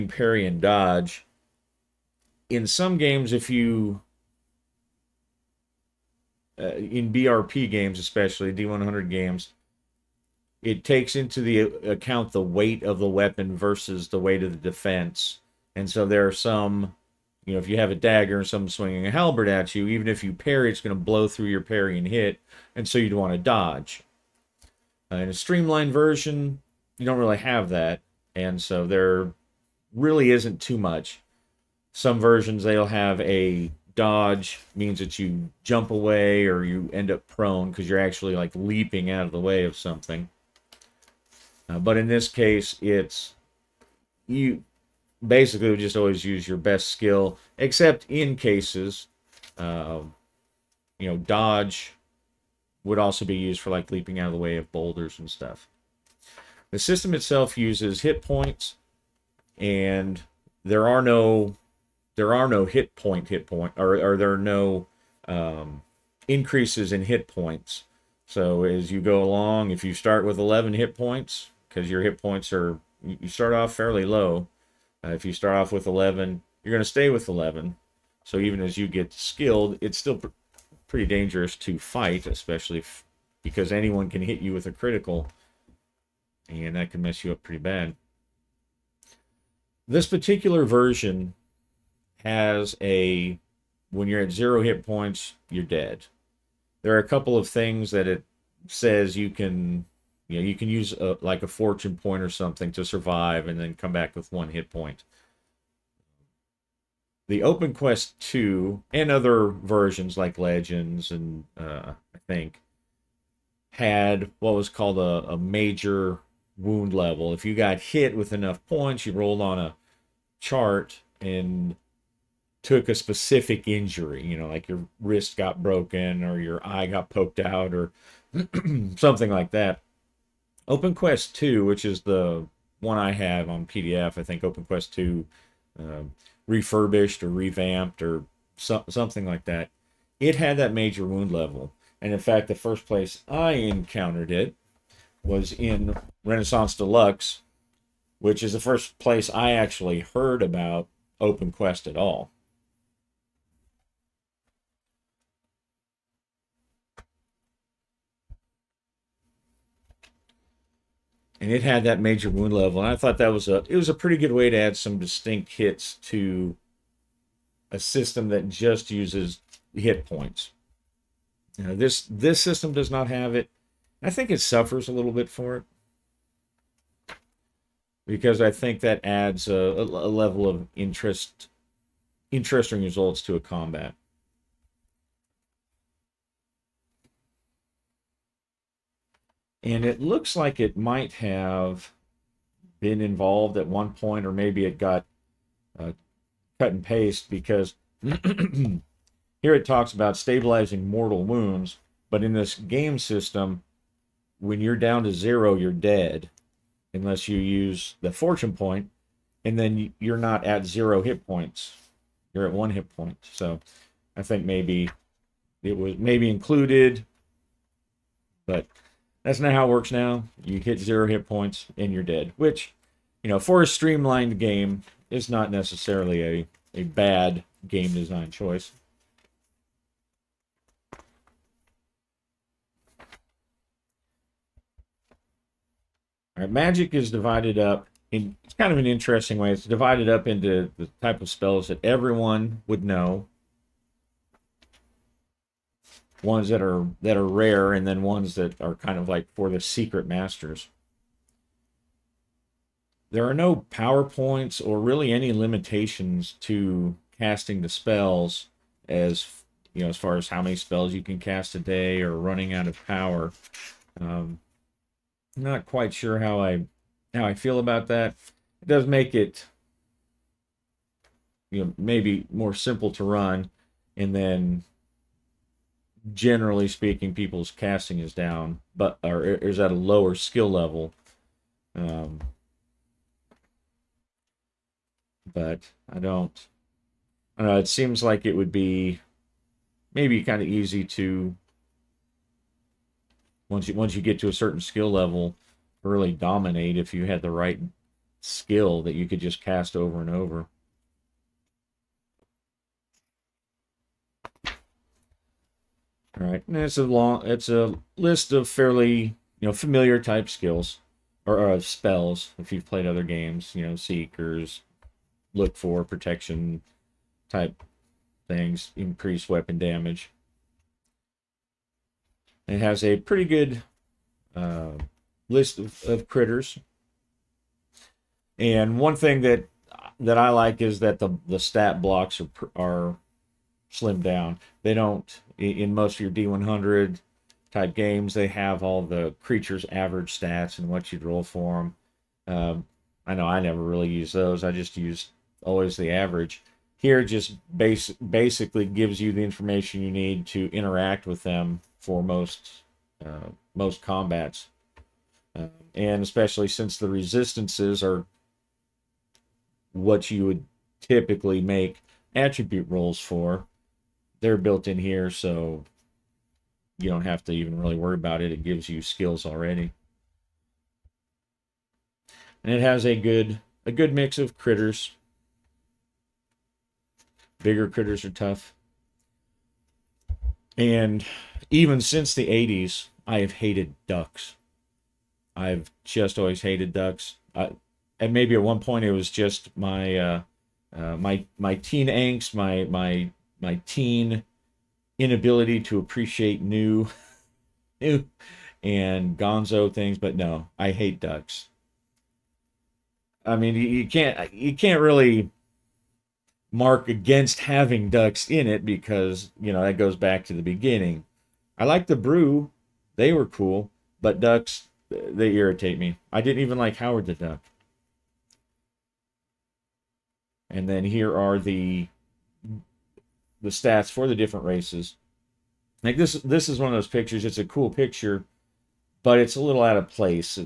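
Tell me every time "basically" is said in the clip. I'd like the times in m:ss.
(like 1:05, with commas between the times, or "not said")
0:45, 5:47.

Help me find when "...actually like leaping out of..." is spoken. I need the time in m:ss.
0:37.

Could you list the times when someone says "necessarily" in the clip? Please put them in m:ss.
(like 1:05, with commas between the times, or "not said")
3:45.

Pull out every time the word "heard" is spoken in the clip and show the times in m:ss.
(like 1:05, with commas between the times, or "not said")
2:29.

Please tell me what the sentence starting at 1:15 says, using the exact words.
Uh, if you start off with 11, you're going to stay with 11.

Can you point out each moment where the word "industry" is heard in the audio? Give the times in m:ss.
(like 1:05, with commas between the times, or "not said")
not said.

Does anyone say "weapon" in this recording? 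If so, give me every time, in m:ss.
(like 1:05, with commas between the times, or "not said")
0:13, 5:19.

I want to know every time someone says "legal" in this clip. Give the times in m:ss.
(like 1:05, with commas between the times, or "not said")
not said.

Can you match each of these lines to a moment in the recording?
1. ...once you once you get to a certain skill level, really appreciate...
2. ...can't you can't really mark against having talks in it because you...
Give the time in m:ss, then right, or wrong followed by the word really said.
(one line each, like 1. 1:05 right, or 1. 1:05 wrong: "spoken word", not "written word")
1. 4:53 wrong: "dominate", not "appreciate"
2. 6:43 wrong: "ducks", not "talks".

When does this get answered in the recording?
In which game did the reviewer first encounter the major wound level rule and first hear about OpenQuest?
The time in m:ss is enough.
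2:26.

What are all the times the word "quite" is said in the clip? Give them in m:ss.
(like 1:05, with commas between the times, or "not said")
4:25.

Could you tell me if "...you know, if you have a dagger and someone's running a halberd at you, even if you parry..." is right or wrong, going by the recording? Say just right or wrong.
wrong.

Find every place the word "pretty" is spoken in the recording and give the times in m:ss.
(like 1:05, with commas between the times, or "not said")
1:20, 1:27, 2:43, 5:22.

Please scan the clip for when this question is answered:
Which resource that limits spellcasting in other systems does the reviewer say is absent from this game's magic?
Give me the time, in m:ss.
4:13.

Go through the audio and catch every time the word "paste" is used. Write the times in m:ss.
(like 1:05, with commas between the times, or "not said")
3:16.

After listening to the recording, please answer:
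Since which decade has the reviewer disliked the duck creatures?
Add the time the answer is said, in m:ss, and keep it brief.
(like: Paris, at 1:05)
the 80s, at 6:22.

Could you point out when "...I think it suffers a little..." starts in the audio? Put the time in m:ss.
2:54.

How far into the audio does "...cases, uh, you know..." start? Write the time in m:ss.
0:48.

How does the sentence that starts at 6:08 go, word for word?
It gives you skills already, and it has a good a good mix of critters.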